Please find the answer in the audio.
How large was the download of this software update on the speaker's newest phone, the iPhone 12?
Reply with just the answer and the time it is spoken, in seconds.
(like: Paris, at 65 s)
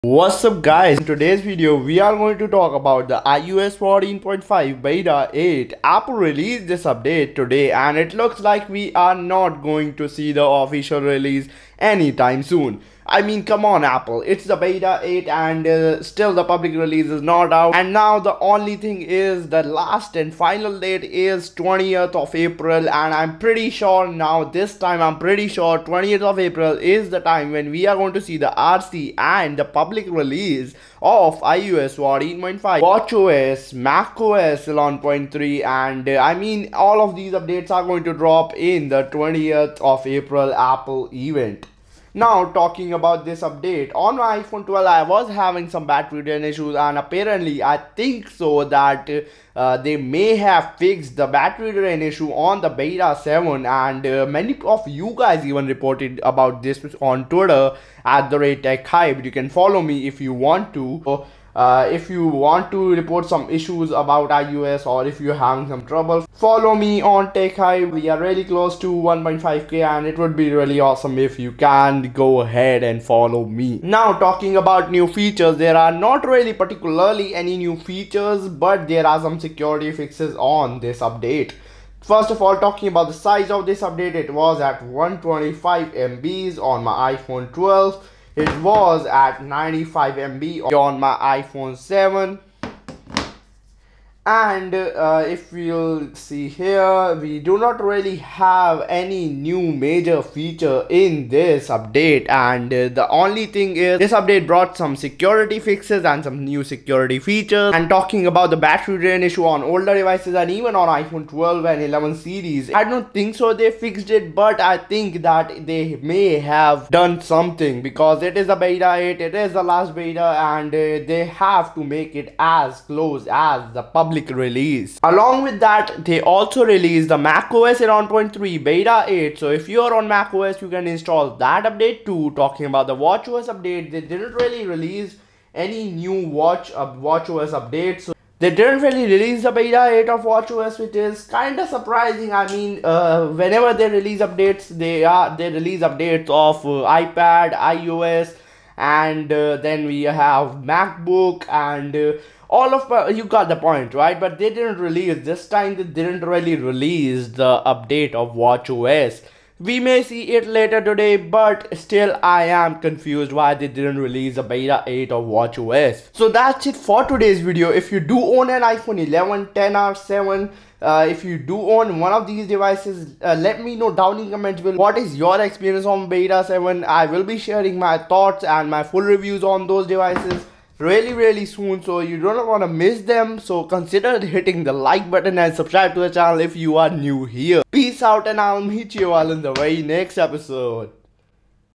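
125 MB, at 84 s.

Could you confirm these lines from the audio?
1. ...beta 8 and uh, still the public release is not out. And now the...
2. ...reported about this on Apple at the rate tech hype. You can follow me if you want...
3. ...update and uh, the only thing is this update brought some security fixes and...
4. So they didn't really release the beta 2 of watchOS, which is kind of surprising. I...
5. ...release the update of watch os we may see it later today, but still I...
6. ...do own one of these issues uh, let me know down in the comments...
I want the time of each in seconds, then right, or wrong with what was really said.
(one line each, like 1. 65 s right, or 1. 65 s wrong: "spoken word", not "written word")
1. 14 s right
2. 55 s wrong: "Twitter", not "Apple"
3. 101 s right
4. 138 s wrong: "8", not "2"
5. 156 s right
6. 171 s wrong: "devices", not "issues".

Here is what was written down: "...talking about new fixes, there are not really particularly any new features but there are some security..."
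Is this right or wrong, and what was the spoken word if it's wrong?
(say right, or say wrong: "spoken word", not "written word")
wrong: "features", not "fixes".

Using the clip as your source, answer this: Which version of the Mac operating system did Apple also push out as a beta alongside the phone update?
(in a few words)
macOS 11.3 beta 8.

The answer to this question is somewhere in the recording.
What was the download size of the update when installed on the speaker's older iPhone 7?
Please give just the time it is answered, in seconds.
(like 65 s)
89 s.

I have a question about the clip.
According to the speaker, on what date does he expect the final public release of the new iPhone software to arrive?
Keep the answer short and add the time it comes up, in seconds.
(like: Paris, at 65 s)
20th of April, at 25 s.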